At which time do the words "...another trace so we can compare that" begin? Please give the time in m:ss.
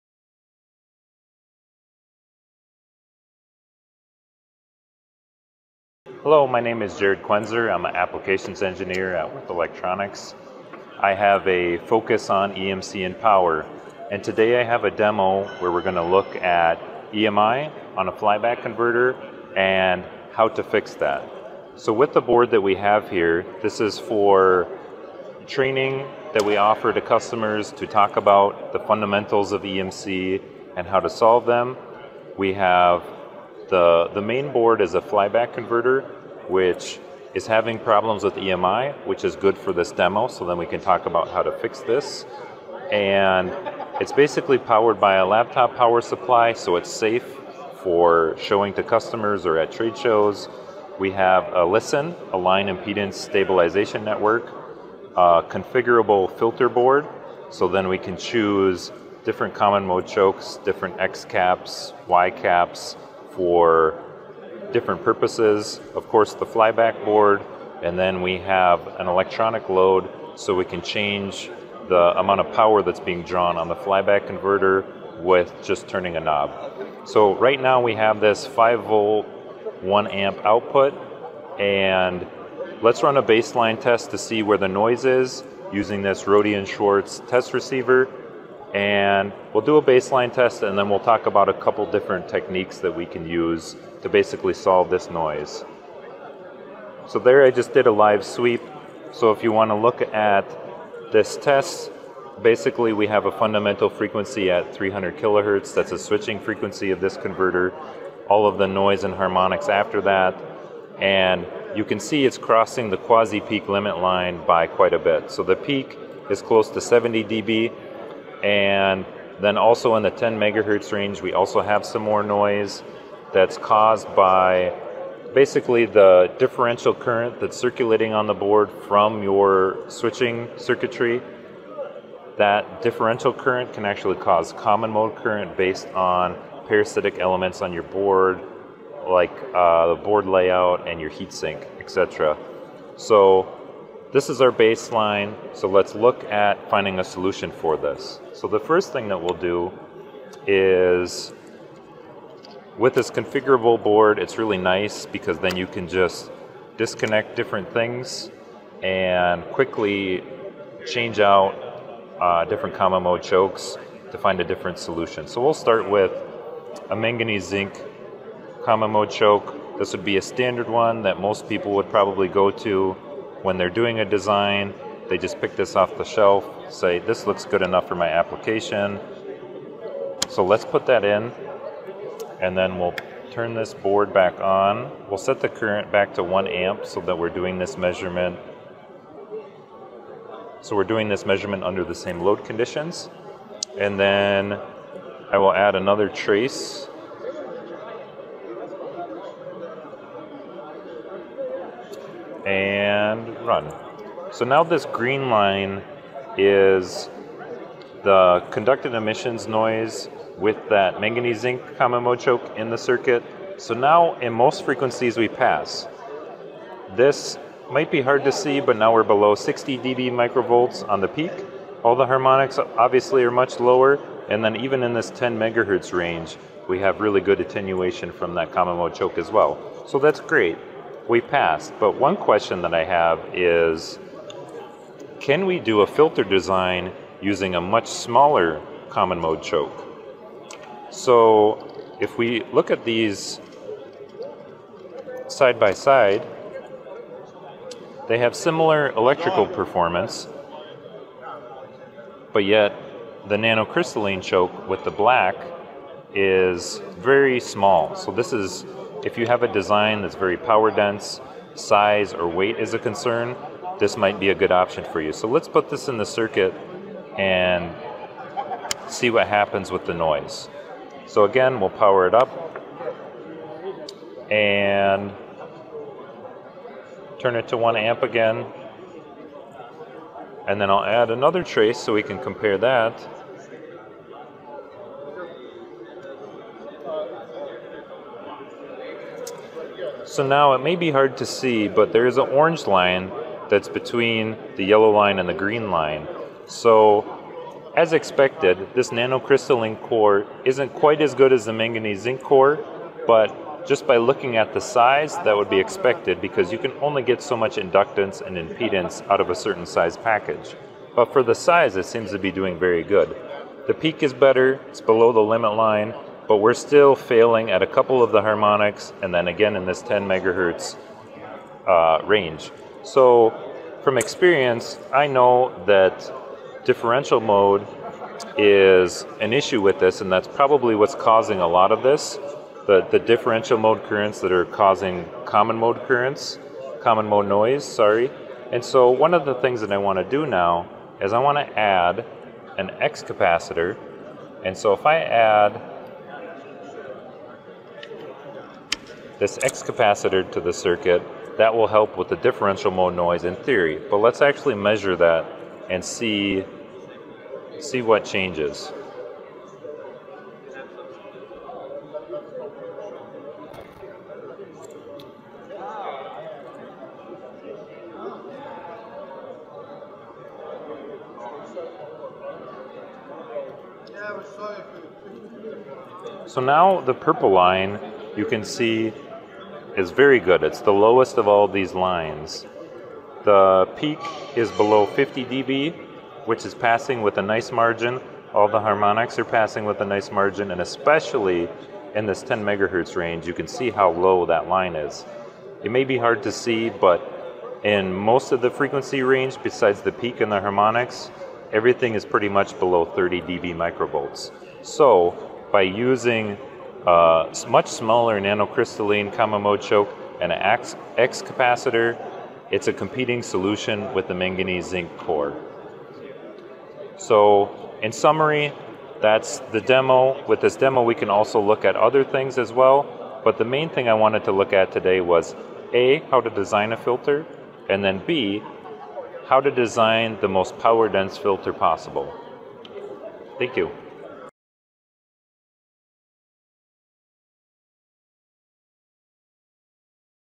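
4:41.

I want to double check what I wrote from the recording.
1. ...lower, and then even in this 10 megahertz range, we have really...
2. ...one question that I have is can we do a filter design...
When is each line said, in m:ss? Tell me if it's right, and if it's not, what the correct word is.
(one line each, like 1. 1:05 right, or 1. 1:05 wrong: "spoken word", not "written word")
1. 3:43 right
2. 3:51 right.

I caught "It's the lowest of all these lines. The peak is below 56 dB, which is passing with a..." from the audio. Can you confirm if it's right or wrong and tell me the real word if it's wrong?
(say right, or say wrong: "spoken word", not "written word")
wrong: "50", not "56".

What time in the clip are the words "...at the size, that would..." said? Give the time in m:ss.
5:04.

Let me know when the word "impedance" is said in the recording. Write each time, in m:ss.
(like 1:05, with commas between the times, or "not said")
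0:52, 5:08.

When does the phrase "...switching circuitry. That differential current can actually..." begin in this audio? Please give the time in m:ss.
2:09.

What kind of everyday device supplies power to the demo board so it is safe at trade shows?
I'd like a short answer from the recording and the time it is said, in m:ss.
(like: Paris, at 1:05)
laptop power supply, at 0:45.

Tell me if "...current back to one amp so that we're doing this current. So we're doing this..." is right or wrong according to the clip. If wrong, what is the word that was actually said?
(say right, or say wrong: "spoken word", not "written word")
wrong: "measurement", not "current".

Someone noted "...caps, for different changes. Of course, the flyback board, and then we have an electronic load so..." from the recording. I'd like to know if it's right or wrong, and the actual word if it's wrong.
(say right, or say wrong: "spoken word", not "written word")
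wrong: "purposes", not "changes".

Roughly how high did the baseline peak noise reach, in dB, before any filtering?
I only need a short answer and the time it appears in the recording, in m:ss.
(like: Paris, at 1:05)
70 dB, at 1:56.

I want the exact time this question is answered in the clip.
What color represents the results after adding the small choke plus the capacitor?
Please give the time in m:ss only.
6:16.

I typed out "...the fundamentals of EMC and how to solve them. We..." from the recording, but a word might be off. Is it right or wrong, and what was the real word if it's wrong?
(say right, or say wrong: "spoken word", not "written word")
right.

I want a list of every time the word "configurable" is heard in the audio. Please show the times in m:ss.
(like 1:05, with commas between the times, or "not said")
0:55, 2:33.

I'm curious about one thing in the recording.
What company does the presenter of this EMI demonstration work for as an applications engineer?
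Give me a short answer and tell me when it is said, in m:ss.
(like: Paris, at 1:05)
Würth Electronics, at 0:09.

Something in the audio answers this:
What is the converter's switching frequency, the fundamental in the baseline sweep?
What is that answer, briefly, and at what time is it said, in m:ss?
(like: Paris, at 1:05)
300 kHz, at 1:44.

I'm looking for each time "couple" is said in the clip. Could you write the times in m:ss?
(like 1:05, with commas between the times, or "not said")
1:31, 5:17.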